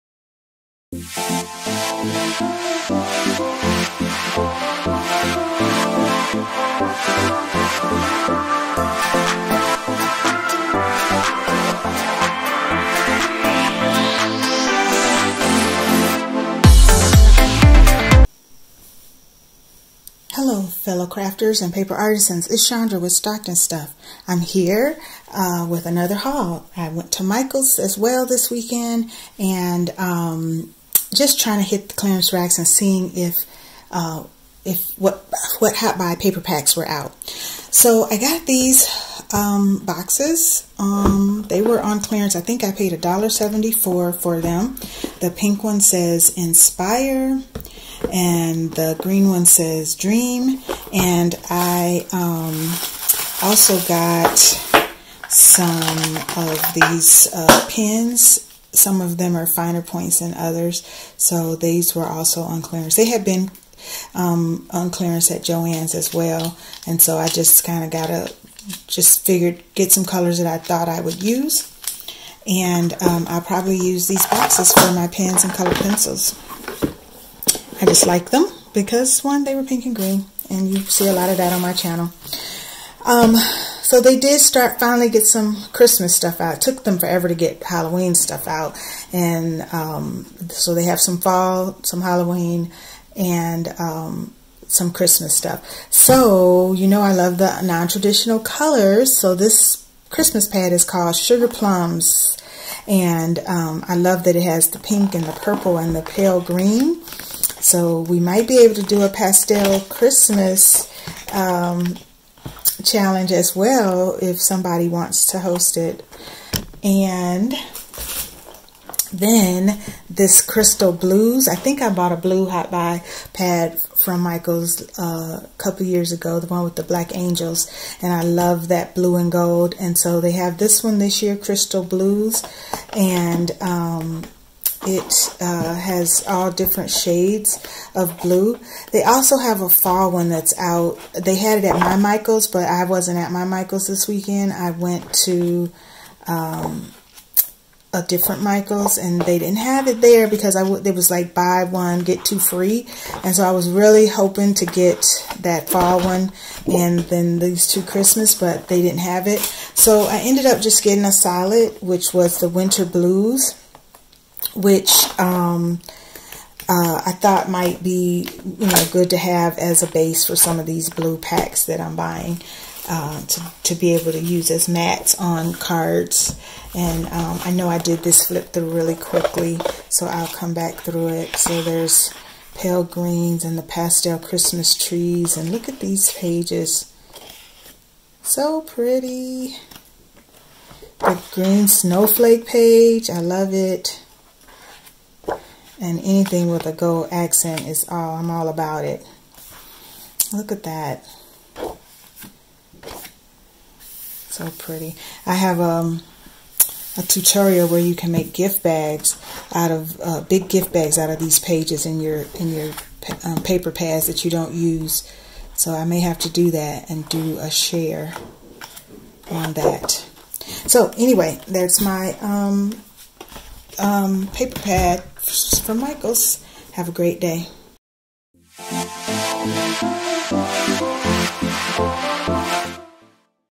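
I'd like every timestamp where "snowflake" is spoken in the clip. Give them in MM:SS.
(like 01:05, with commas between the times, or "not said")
03:11.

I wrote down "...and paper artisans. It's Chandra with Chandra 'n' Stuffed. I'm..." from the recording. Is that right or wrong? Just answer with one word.
wrong.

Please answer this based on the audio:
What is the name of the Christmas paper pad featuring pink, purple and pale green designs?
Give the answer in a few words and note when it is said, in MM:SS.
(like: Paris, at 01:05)
Sugar Plums, at 01:41.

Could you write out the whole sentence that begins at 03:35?
So I may have to do that and do a share on that.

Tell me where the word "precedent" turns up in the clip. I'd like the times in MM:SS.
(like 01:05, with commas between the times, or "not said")
not said.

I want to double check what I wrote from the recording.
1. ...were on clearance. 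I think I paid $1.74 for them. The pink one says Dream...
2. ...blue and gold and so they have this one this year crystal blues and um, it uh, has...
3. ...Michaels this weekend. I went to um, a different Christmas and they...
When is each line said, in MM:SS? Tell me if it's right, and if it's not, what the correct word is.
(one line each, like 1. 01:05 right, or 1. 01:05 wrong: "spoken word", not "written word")
1. 00:41 wrong: "Inspire", not "Dream"
2. 02:08 right
3. 02:23 wrong: "Michaels", not "Christmas".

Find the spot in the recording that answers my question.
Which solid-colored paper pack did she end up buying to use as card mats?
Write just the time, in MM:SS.
02:42.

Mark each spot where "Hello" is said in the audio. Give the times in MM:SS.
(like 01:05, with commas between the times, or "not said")
00:20.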